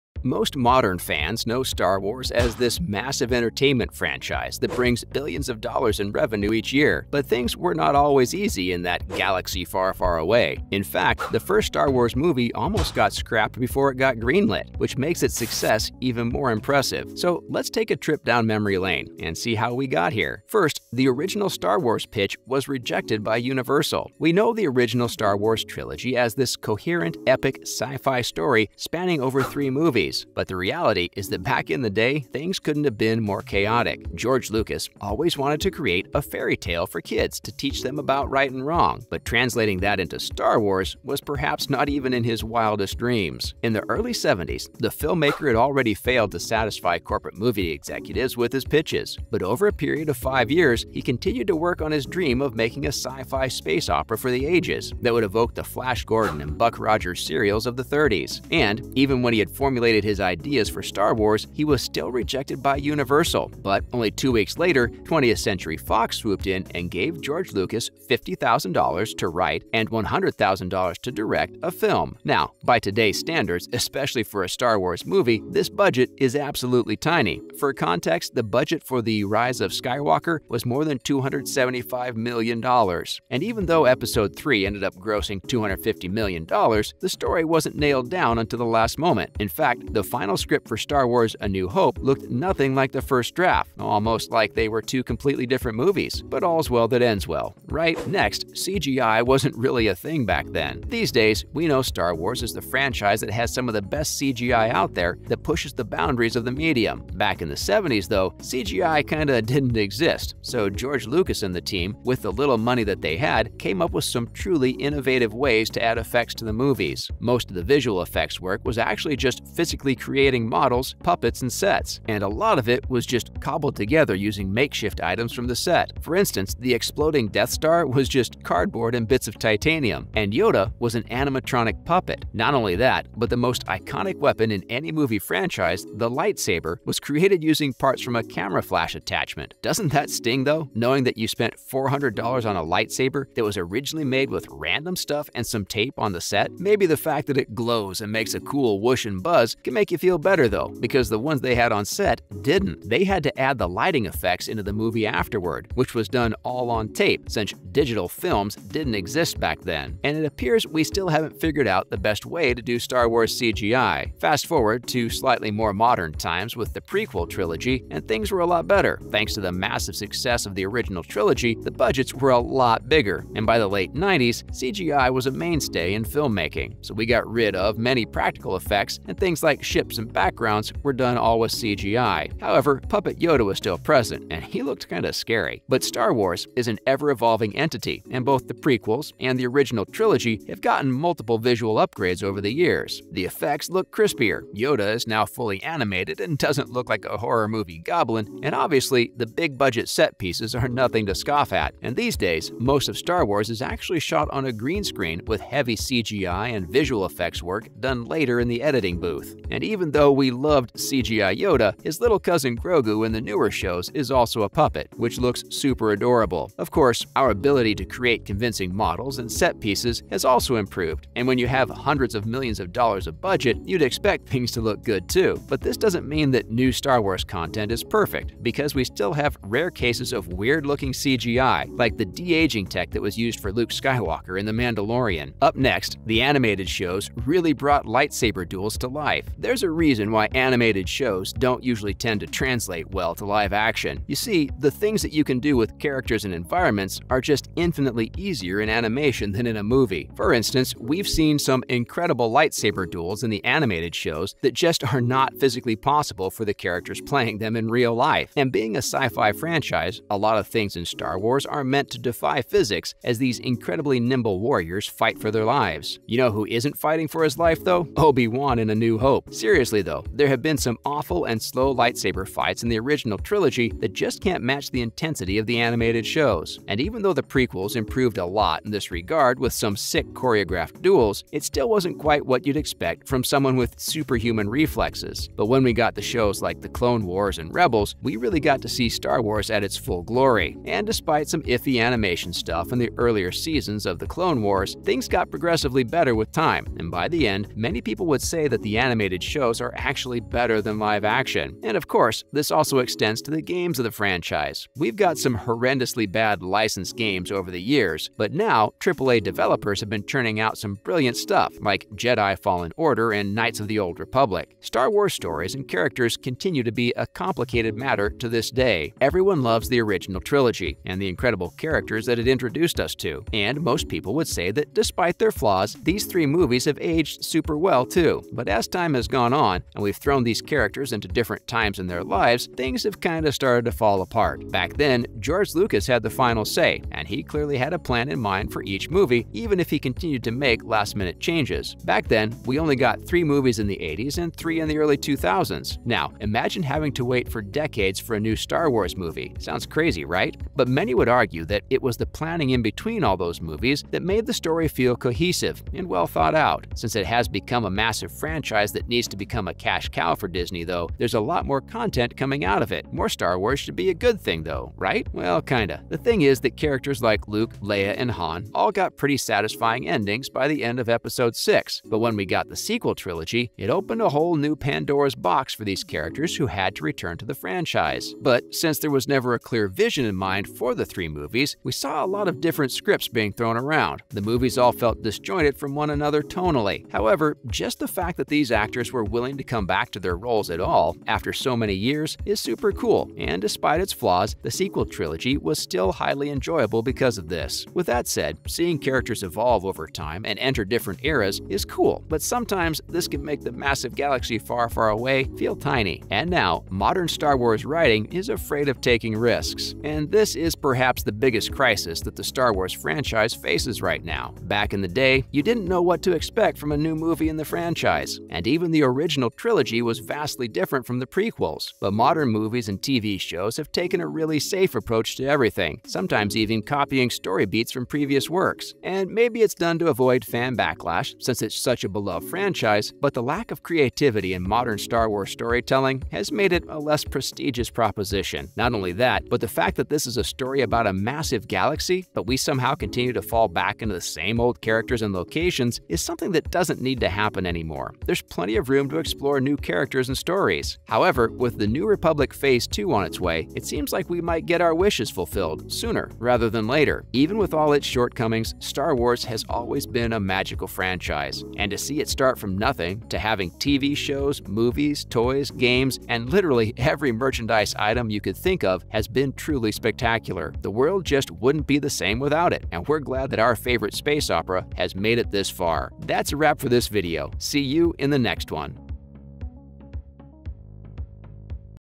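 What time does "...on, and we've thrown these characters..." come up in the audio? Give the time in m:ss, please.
5:29.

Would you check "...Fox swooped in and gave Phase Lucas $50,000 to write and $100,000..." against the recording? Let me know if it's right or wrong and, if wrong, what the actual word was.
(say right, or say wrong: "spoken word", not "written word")
wrong: "George", not "Phase".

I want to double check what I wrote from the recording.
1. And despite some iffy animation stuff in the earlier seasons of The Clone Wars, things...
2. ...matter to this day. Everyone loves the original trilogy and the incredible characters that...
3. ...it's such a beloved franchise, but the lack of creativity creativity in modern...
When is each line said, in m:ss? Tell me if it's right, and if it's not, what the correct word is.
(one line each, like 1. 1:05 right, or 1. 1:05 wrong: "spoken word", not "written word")
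1. 4:50 right
2. 5:17 right
3. 7:11 right.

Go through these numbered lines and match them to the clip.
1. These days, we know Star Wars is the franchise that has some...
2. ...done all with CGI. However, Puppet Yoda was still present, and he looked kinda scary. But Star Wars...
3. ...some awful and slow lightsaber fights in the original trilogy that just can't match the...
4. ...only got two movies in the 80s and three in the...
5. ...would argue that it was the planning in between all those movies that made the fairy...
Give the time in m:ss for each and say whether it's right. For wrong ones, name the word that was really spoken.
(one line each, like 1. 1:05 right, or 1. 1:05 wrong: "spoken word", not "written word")
1. 1:40 right
2. 3:01 right
3. 4:30 right
4. 5:42 wrong: "three", not "two"
5. 5:50 wrong: "story", not "fairy".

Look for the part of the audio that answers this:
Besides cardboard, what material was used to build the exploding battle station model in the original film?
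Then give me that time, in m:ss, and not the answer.
2:09.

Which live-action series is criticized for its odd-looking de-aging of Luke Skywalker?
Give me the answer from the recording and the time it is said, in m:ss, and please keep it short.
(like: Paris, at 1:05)
The Mandalorian, at 3:54.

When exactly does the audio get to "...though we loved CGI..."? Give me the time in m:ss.
3:29.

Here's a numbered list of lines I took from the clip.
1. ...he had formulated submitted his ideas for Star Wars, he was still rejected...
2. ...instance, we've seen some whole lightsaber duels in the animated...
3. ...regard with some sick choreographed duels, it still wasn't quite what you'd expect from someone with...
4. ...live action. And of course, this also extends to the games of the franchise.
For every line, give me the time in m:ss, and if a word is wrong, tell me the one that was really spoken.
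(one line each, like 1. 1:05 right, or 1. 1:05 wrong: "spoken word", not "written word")
1. 0:59 right
2. 4:10 wrong: "incredible", not "whole"
3. 4:38 right
4. 5:00 right.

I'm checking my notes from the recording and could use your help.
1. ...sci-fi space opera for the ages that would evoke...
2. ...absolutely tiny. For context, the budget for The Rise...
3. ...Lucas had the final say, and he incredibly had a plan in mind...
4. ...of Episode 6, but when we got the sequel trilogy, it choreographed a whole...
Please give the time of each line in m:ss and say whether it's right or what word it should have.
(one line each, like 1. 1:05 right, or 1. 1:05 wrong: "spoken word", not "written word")
1. 0:52 right
2. 1:16 right
3. 5:35 wrong: "clearly", not "incredibly"
4. 6:10 wrong: "opened", not "choreographed".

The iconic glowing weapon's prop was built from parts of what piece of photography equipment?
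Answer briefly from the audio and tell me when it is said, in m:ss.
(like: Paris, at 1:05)
camera flash attachment, at 2:18.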